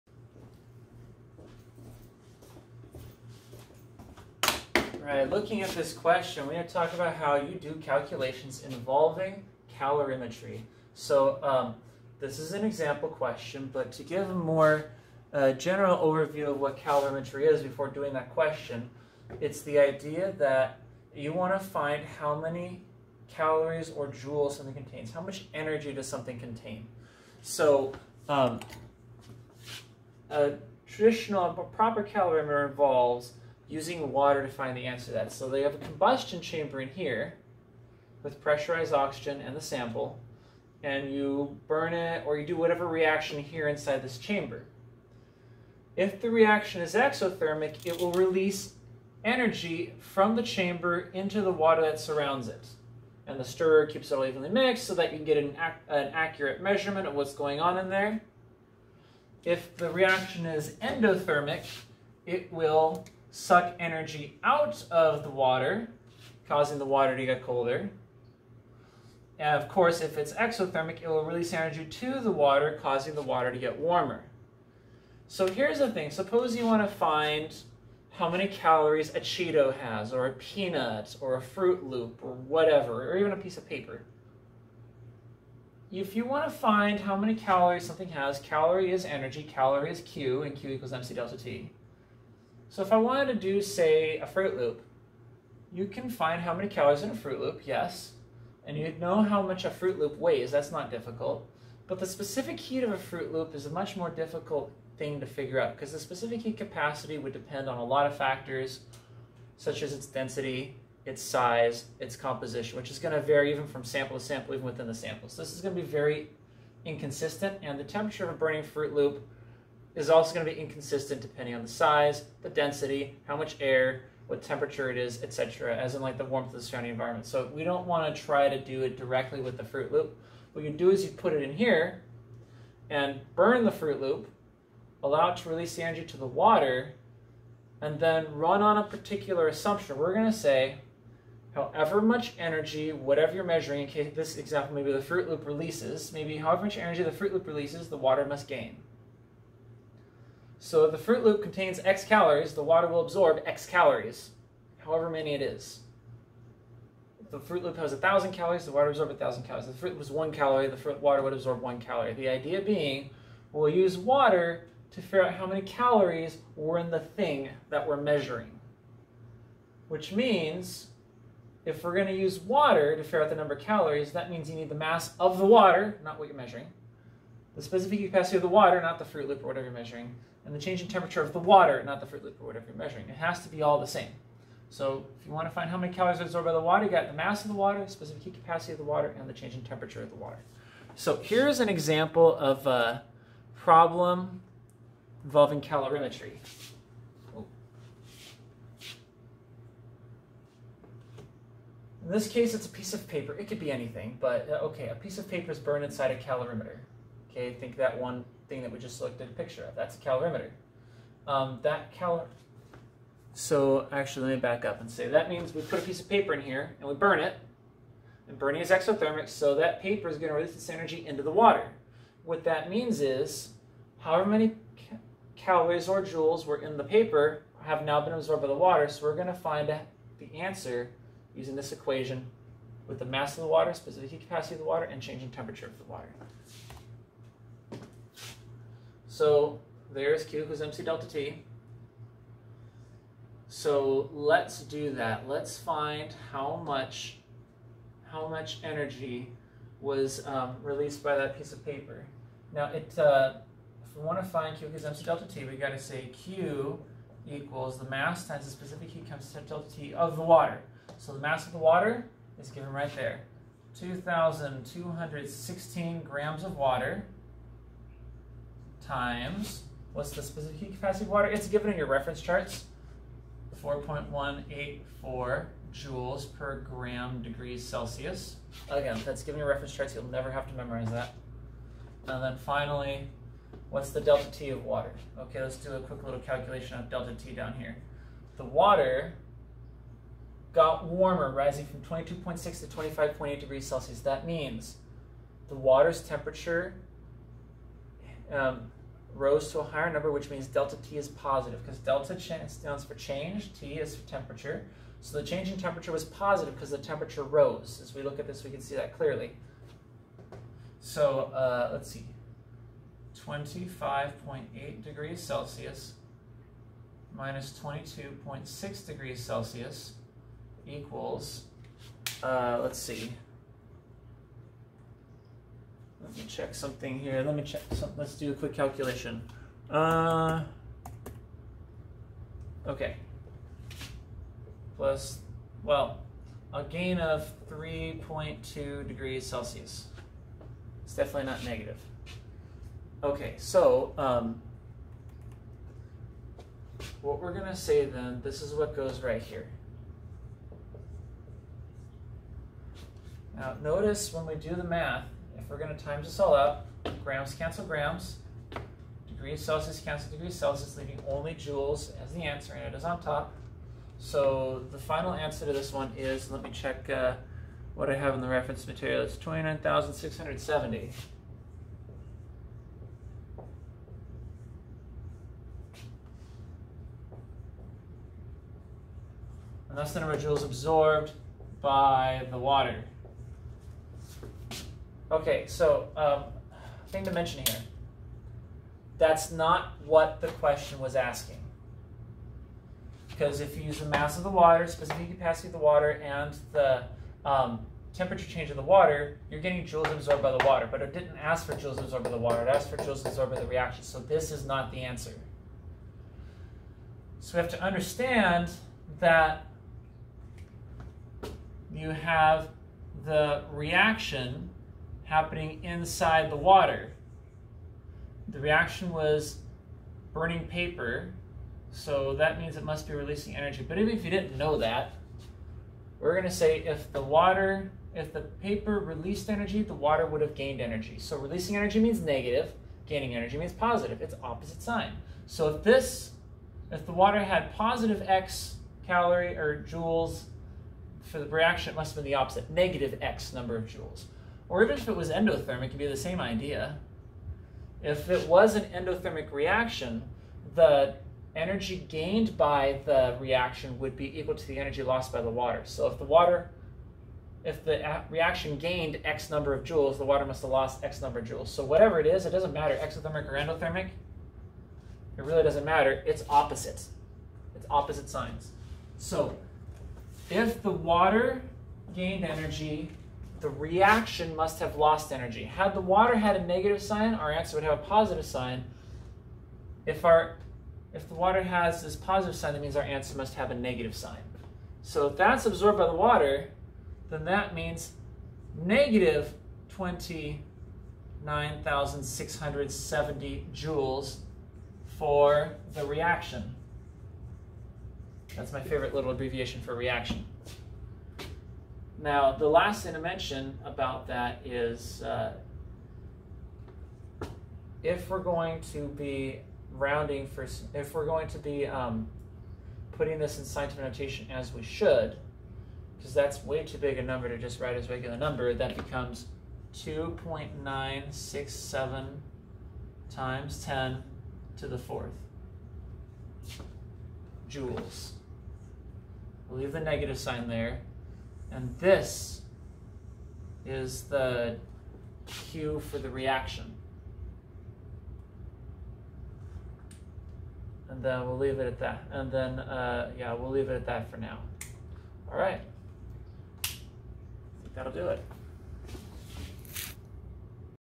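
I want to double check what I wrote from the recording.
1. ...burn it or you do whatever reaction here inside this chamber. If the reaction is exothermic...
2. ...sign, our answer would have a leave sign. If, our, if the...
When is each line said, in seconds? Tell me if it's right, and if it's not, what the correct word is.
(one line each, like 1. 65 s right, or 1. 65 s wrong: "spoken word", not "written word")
1. 41 s right
2. 476 s wrong: "positive", not "leave".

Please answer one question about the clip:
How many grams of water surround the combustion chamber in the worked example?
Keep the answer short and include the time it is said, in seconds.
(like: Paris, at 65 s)
2,216 grams, at 263 s.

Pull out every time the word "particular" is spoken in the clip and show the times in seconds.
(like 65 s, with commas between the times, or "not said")
138 s.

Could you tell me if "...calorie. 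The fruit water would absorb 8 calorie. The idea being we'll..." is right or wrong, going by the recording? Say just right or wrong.
wrong.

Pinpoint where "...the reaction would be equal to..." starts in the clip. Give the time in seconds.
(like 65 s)
452 s.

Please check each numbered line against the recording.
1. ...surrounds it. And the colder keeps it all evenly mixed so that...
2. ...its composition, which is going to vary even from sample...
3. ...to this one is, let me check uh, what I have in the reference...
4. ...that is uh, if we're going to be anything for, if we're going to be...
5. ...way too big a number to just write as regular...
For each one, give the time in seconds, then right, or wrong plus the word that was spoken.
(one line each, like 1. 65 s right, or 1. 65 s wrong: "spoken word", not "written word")
1. 51 s wrong: "stirrer", not "colder"
2. 111 s right
3. 365 s right
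4. 504 s wrong: "rounding", not "anything"
5. 516 s right.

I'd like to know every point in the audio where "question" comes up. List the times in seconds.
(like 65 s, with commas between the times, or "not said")
5 s, 13 s, 18 s, 390 s.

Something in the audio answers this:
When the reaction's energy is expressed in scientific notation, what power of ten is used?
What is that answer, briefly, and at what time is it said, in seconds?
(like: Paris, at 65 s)
10 to the fourth, at 523 s.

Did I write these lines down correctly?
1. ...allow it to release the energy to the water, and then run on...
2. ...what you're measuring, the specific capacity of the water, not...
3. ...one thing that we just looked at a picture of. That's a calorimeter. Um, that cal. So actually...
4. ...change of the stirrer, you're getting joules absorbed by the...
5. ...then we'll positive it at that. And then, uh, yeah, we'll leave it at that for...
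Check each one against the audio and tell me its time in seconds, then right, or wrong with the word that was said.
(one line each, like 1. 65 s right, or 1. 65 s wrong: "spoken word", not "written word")
1. 135 s right
2. 176 s right
3. 207 s right
4. 398 s wrong: "water", not "stirrer"
5. 541 s wrong: "leave", not "positive".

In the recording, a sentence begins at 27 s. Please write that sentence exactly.
So um, a traditional, a proper calorimeter involves using water to find the answer to that.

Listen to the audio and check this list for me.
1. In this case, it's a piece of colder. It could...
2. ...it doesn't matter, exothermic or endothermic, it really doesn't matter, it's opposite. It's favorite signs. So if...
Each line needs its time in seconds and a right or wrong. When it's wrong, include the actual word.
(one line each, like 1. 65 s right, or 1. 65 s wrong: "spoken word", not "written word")
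1. 202 s wrong: "paper", not "colder"
2. 462 s wrong: "opposite", not "favorite".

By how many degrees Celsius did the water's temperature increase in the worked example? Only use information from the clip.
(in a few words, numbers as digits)
3.2.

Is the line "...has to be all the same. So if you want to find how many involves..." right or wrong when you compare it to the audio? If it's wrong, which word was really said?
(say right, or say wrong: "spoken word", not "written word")
wrong: "calories", not "involves".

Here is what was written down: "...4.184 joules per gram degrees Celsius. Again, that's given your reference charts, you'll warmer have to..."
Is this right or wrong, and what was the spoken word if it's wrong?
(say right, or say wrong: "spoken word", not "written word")
wrong: "never", not "warmer".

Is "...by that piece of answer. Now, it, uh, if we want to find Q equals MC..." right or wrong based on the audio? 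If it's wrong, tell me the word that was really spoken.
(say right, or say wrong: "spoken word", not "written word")
wrong: "paper", not "answer".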